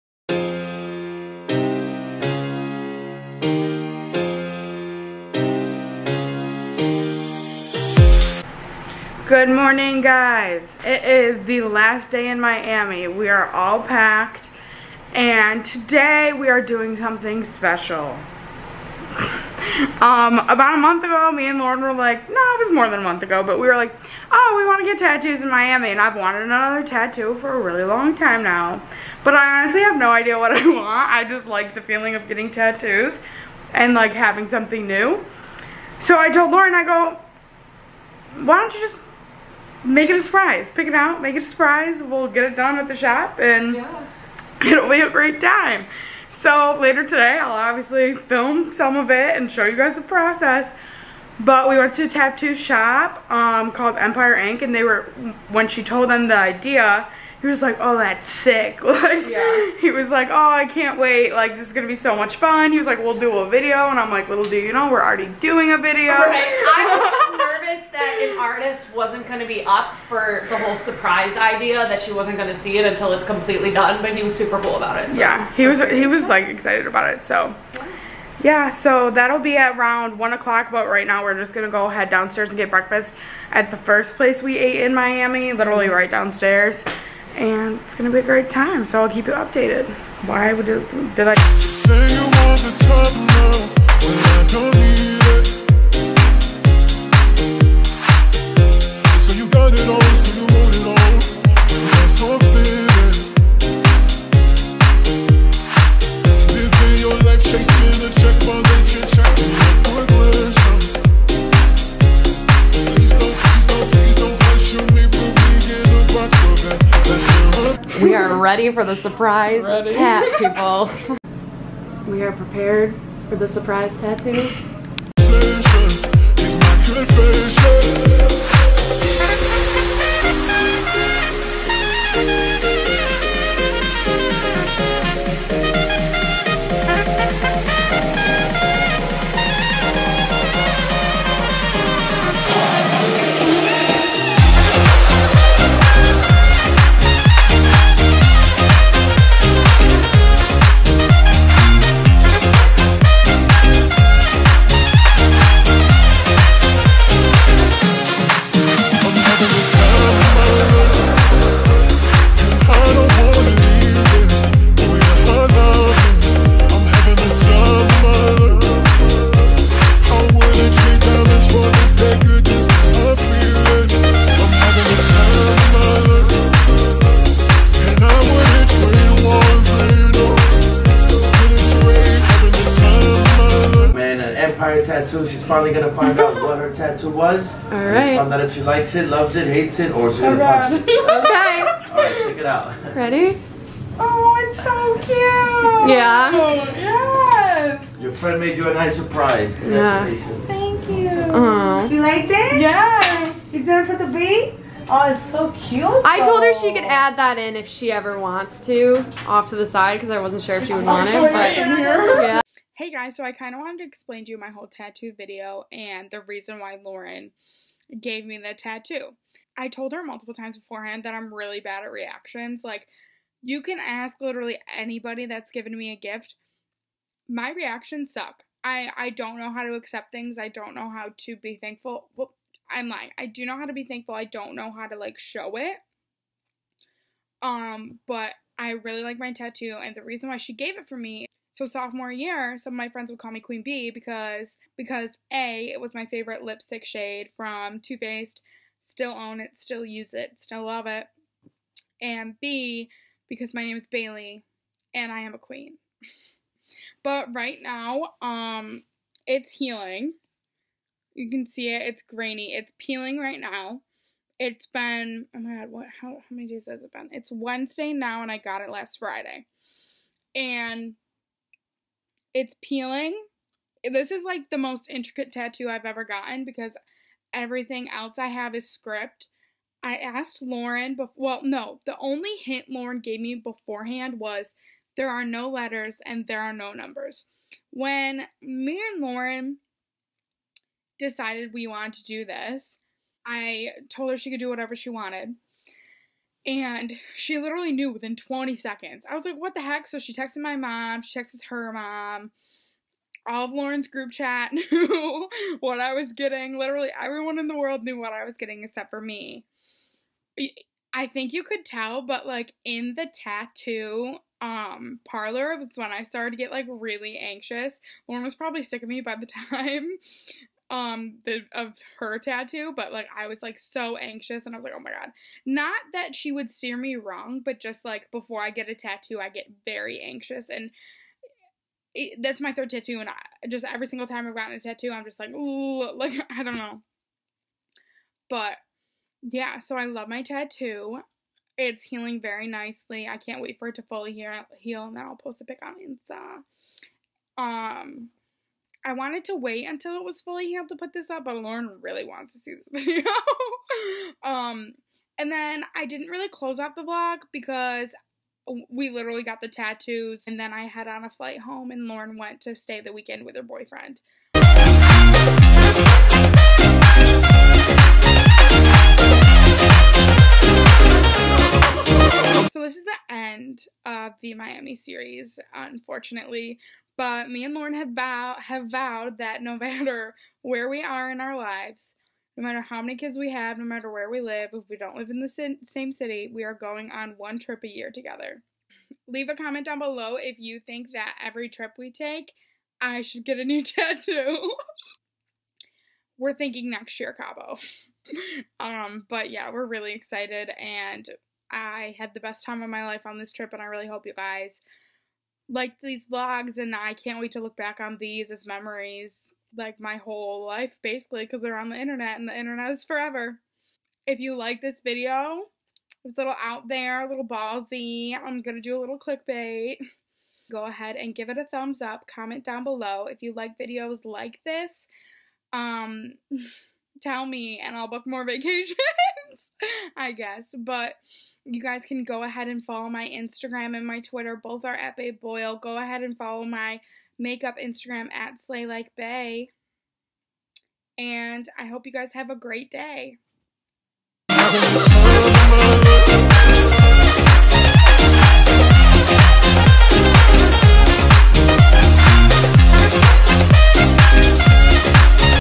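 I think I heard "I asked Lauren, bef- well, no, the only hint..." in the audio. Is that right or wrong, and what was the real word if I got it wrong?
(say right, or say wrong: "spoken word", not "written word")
right.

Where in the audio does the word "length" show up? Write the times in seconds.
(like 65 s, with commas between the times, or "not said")
not said.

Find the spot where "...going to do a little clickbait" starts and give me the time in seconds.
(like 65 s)
418 s.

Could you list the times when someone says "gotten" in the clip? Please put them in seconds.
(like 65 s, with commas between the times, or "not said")
276 s, 334 s.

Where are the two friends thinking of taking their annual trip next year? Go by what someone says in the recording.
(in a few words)
Cabo.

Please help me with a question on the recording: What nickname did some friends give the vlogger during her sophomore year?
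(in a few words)
Queen Bee.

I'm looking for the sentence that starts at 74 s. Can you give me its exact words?
But he was super cool about it.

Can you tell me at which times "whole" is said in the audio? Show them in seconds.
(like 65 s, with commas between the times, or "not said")
70 s, 214 s, 409 s.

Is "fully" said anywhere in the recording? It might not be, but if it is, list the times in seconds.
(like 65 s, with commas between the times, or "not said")
343 s, 350 s.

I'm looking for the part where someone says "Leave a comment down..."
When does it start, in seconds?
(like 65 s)
389 s.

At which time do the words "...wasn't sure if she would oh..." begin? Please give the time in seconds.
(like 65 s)
210 s.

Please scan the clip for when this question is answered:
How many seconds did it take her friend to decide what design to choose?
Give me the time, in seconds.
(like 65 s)
298 s.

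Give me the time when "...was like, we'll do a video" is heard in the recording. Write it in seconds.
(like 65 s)
62 s.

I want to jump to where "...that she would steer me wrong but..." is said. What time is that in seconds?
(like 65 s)
325 s.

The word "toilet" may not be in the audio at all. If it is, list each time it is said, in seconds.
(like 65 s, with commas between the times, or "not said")
not said.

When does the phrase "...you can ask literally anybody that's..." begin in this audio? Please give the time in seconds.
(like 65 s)
223 s.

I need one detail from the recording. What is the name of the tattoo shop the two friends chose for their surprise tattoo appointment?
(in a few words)
Empire Ink.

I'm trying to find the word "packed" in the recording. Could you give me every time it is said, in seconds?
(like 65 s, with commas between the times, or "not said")
13 s.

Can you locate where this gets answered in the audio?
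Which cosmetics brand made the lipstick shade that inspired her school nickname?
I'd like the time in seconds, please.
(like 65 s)
247 s.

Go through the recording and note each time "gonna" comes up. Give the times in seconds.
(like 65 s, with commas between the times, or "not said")
87 s, 185 s, 190 s.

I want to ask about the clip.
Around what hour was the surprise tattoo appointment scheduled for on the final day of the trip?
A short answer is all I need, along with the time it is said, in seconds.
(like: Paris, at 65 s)
1 o'clock, at 80 s.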